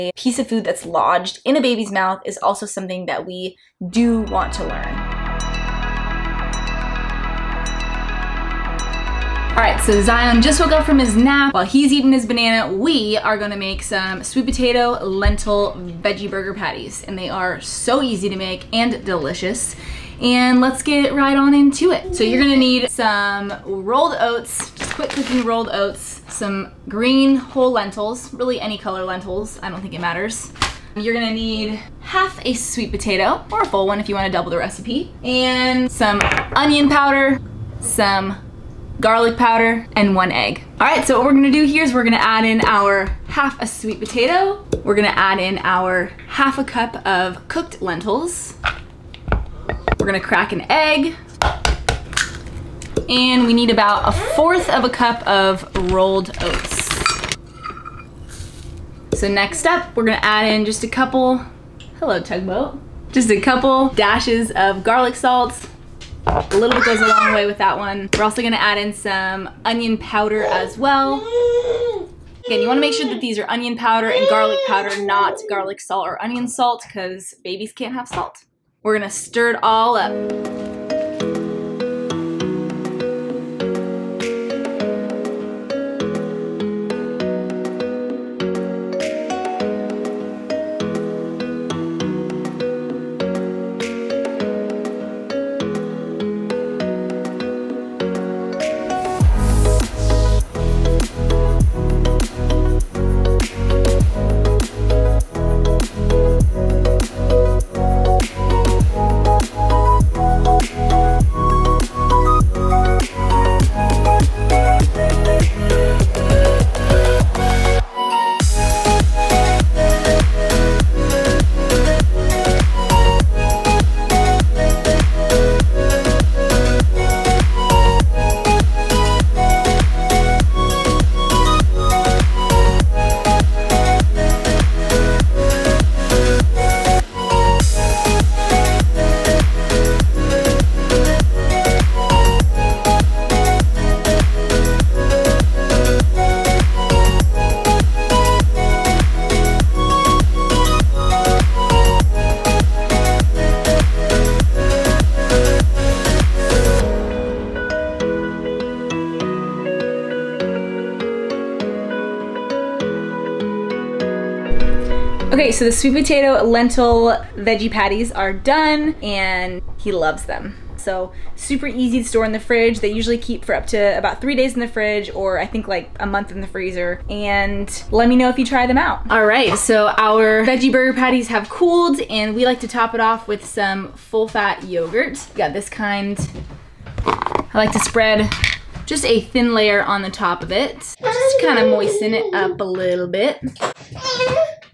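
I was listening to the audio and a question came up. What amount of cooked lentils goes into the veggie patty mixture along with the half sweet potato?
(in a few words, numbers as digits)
half a cup.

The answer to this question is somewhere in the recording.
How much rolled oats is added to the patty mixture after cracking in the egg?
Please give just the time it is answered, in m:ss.
0:54.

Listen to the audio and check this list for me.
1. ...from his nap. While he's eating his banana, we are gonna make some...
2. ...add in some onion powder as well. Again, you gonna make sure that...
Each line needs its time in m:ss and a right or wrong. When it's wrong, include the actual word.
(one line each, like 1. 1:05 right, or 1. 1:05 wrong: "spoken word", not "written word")
1. 0:10 right
2. 1:08 wrong: "wanna", not "gonna".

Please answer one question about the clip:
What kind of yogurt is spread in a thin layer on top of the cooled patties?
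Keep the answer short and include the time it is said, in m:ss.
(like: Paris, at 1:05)
full fat yogurt, at 3:03.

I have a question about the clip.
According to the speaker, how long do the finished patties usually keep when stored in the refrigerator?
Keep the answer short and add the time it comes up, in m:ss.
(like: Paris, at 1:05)
3 days, at 2:54.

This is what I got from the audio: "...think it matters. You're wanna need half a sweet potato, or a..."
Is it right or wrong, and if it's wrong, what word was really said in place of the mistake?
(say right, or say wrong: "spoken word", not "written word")
wrong: "gonna", not "wanna".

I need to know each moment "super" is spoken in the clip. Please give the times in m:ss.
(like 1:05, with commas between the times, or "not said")
2:51.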